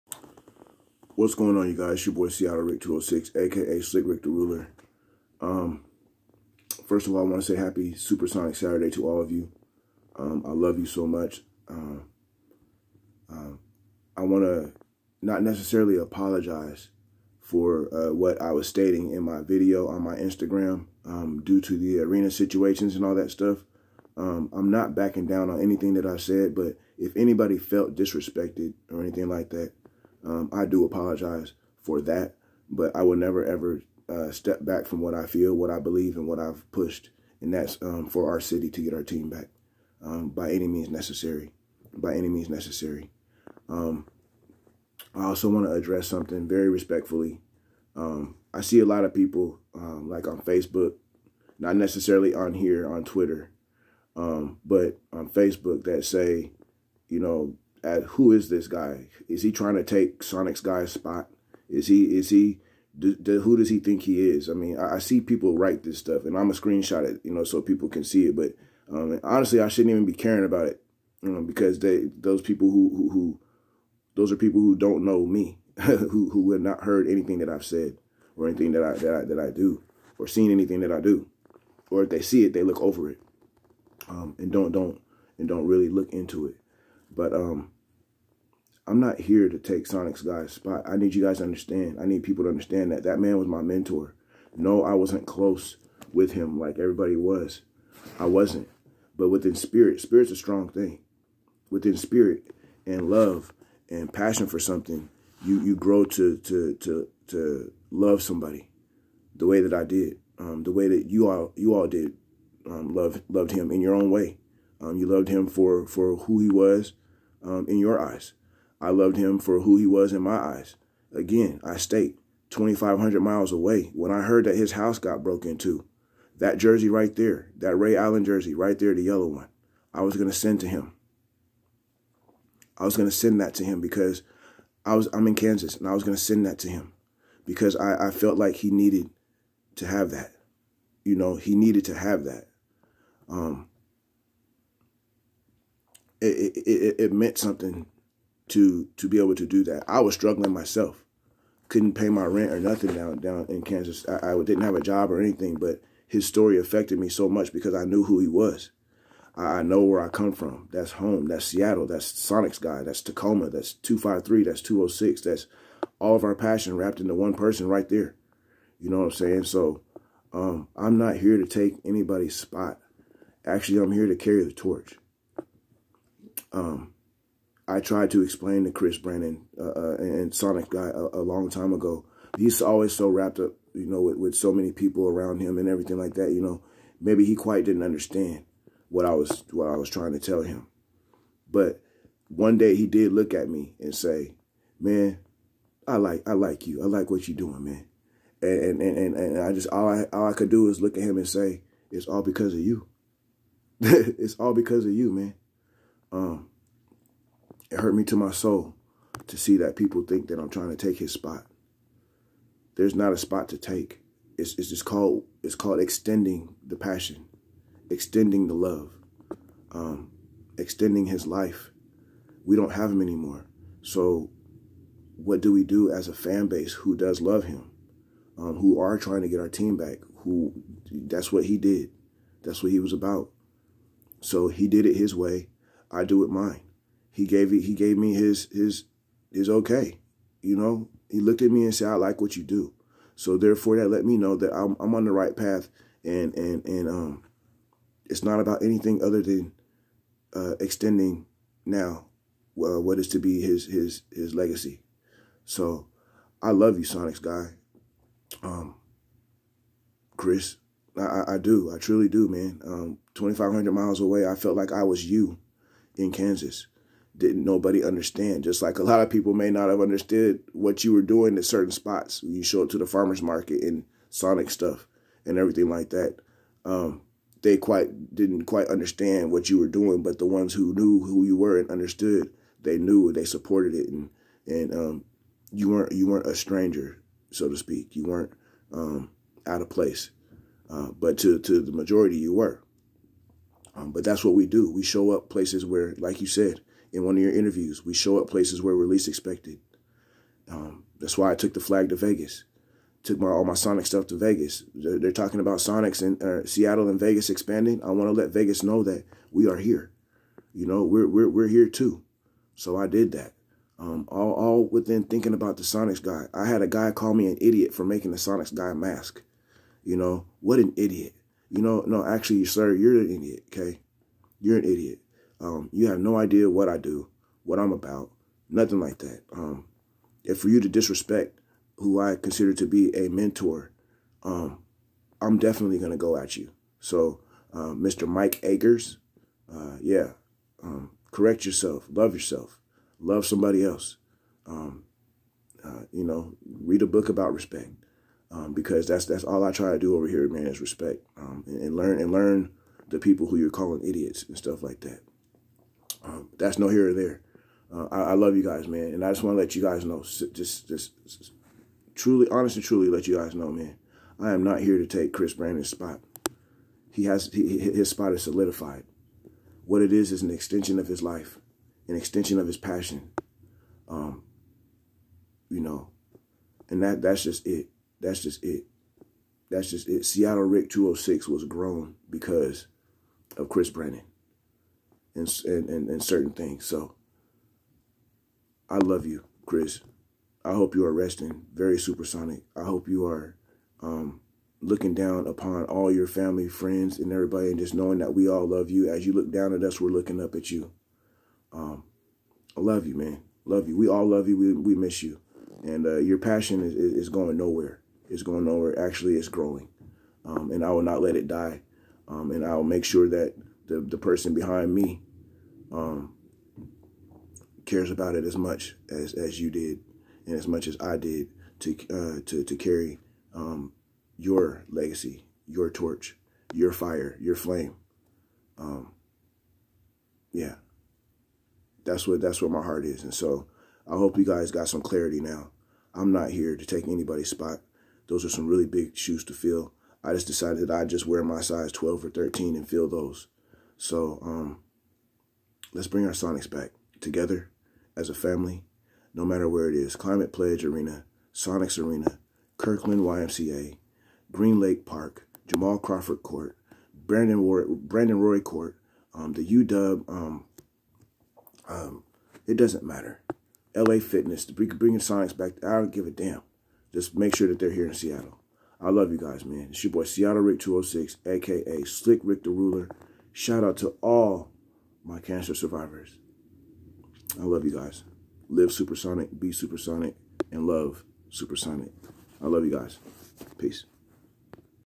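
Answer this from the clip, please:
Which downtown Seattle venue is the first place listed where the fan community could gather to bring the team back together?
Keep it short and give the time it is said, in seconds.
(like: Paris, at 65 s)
Climate Pledge Arena, at 449 s.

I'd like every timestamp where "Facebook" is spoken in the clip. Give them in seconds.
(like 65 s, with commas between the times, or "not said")
50 s, 55 s.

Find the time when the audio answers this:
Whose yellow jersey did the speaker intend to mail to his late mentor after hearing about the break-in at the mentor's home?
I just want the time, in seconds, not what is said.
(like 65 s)
127 s.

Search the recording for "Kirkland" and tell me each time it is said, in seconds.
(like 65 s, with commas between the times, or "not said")
452 s.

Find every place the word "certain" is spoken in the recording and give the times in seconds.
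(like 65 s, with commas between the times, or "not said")
271 s, 386 s.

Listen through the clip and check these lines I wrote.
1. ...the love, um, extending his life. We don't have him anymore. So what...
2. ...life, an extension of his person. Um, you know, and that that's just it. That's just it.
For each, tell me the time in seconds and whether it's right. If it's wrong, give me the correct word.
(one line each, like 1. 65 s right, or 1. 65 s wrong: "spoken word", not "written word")
1. 218 s right
2. 371 s wrong: "passion", not "person".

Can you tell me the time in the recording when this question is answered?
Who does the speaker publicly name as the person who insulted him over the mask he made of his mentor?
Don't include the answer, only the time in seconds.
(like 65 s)
338 s.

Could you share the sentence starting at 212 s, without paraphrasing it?
There's not a spot to take.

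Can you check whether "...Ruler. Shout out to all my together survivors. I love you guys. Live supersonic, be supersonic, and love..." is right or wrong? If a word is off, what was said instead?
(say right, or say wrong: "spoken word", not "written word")
wrong: "cancer", not "together".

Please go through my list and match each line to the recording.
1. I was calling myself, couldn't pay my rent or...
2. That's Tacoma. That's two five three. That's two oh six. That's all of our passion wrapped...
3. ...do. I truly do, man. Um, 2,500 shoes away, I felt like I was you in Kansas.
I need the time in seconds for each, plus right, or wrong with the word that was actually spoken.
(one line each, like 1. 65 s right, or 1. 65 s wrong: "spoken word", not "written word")
1. 149 s wrong: "struggling", not "calling"
2. 162 s right
3. 261 s wrong: "miles", not "shoes".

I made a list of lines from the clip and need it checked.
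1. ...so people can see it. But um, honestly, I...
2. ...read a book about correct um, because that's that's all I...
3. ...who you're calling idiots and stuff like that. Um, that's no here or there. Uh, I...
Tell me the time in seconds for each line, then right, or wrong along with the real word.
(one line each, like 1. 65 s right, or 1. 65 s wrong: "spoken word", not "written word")
1. 67 s right
2. 346 s wrong: "respect", not "correct"
3. 353 s right.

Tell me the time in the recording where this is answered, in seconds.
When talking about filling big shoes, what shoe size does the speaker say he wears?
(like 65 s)
441 s.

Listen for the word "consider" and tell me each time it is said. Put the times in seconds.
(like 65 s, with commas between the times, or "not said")
332 s.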